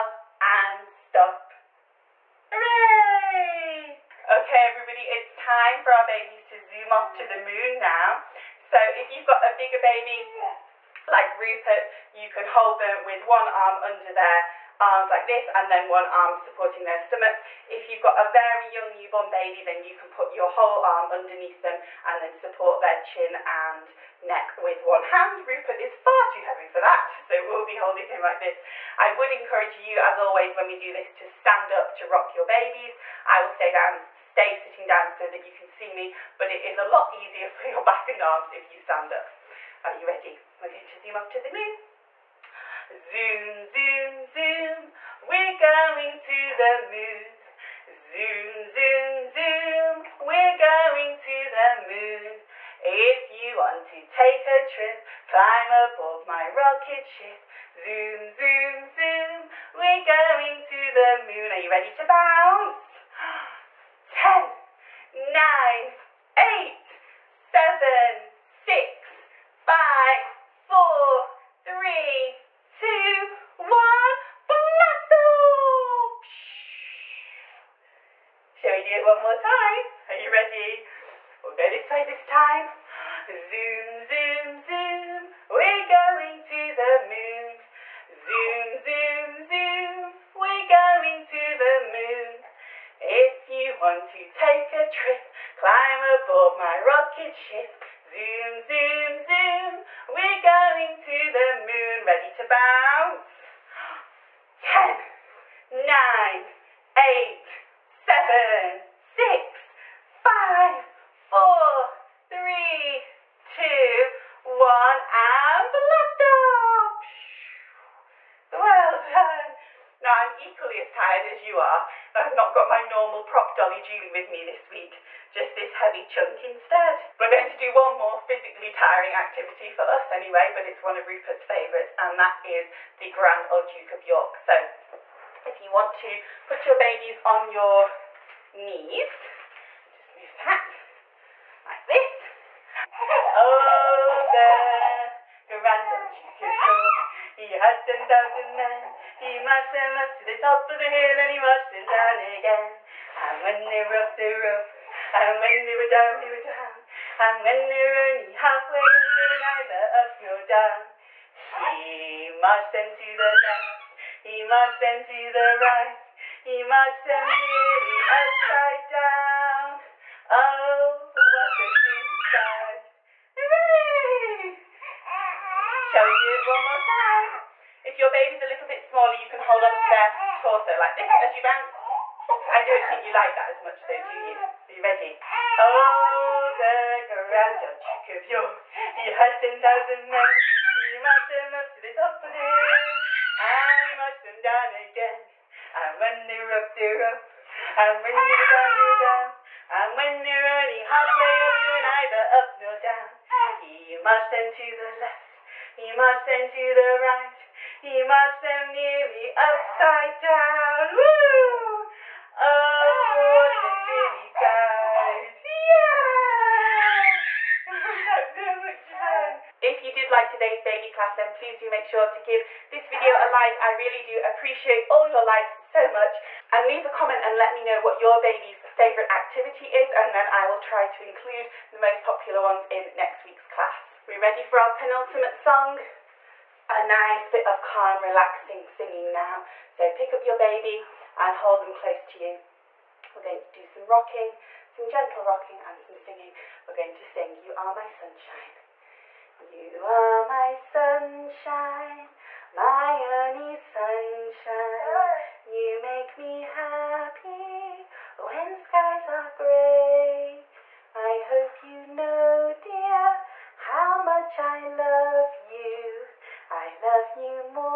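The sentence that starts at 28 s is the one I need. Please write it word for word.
I would encourage you as always when we do this to stand up to rock your babies.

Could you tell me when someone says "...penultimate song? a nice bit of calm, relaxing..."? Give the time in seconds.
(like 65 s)
234 s.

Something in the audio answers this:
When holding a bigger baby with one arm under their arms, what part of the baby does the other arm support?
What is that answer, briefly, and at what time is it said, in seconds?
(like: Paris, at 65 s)
stomach, at 17 s.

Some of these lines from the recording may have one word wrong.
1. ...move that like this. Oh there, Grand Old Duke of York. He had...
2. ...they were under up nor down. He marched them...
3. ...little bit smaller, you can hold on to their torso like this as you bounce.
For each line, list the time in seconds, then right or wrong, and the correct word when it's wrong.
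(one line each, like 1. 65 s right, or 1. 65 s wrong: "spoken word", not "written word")
1. 140 s right
2. 158 s wrong: "neither", not "under"
3. 178 s right.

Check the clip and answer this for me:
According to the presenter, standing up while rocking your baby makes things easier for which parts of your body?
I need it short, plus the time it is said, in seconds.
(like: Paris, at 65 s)
back and arms, at 37 s.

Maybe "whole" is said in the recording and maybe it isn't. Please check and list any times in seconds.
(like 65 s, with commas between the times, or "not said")
20 s.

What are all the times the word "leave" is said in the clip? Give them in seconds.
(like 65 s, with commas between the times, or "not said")
226 s.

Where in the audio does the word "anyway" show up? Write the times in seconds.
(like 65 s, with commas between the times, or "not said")
130 s.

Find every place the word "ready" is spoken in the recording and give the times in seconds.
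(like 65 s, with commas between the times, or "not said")
40 s, 61 s, 80 s, 102 s, 184 s, 234 s.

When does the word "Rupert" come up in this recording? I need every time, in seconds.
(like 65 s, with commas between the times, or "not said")
11 s, 25 s, 131 s.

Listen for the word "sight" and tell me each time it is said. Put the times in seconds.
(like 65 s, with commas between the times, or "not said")
172 s, 214 s.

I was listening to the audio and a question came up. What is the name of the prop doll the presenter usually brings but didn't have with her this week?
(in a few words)
Julie.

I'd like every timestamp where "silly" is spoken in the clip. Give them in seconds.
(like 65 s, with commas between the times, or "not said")
171 s, 214 s.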